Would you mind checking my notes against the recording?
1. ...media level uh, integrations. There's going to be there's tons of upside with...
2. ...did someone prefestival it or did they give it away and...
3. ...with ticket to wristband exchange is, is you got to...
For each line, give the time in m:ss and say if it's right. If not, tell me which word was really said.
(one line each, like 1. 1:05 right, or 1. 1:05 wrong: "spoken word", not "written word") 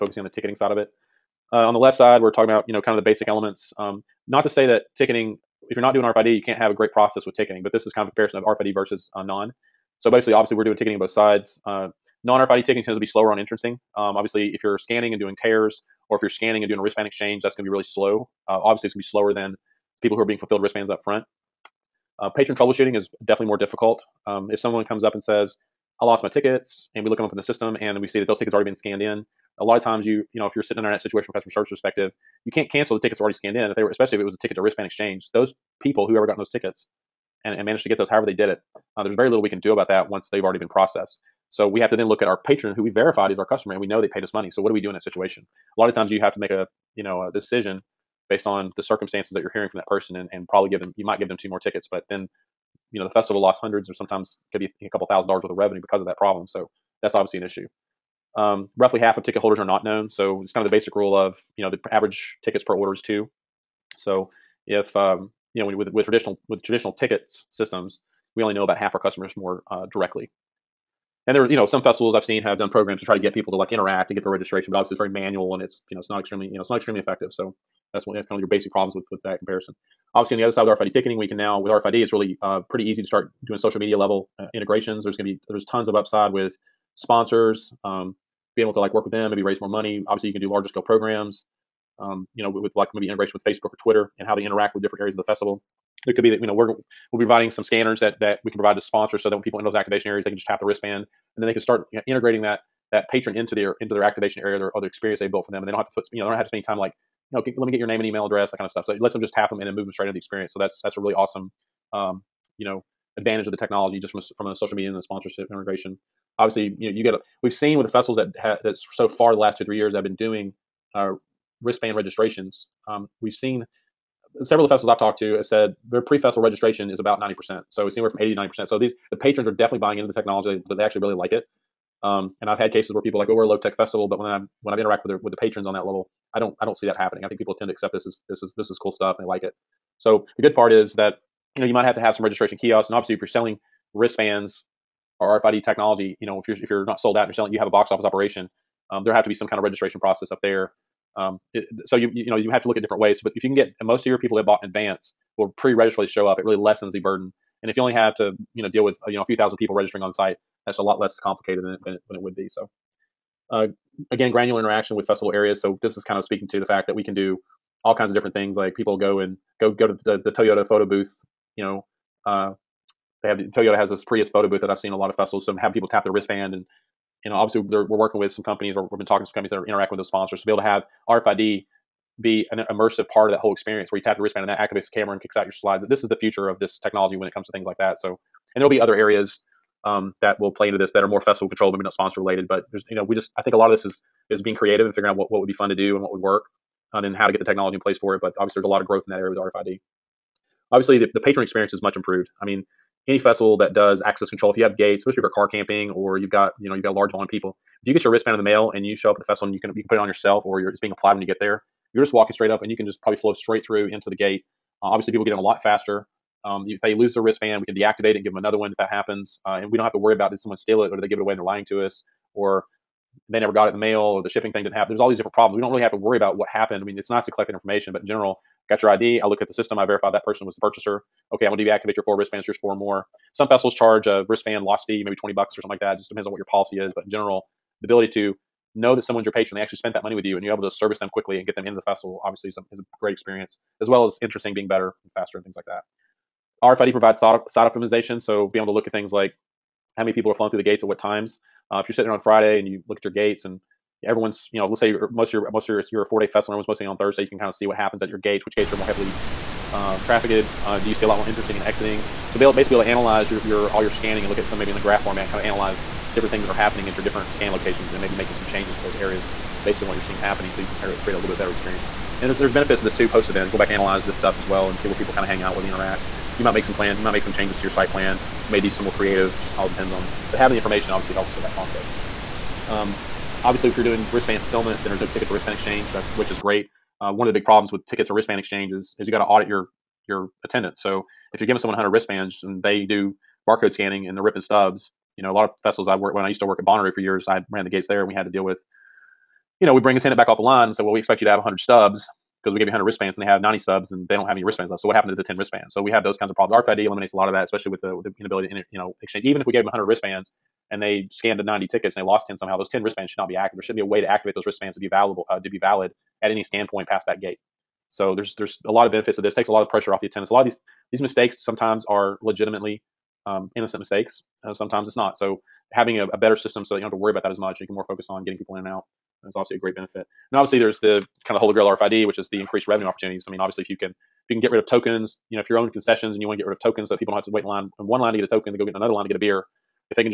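1. 1:23 right
2. 3:40 wrong: "steal", not "prefestival"
3. 4:47 right.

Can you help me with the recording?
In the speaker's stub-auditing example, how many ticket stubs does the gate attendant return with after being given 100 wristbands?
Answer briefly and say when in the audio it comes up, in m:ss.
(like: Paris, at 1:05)
90, at 5:03.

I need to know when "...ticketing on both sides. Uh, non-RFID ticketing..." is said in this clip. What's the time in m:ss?
0:10.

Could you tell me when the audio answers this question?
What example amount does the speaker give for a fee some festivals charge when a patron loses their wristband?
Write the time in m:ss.
3:55.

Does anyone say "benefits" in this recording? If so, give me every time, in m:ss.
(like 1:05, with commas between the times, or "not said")
4:32, 5:18, 5:29.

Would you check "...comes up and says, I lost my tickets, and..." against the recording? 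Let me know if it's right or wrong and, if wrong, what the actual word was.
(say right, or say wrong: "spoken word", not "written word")
right.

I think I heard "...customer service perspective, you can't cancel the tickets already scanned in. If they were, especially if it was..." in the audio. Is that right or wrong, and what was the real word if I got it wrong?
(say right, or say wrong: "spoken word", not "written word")
right.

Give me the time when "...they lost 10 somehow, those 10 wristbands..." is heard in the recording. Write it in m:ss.
5:11.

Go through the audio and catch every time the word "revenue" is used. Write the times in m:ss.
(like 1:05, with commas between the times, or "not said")
0:55, 5:32.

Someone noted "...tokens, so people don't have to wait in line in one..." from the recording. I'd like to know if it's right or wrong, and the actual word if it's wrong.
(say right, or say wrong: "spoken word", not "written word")
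right.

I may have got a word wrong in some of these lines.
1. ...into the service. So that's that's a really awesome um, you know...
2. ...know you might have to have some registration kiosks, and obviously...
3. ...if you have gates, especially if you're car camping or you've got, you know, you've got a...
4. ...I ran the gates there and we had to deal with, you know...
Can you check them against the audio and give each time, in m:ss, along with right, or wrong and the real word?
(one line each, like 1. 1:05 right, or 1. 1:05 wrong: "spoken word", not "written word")
1. 1:50 wrong: "experience", not "service"
2. 2:21 right
3. 3:24 right
4. 4:57 right.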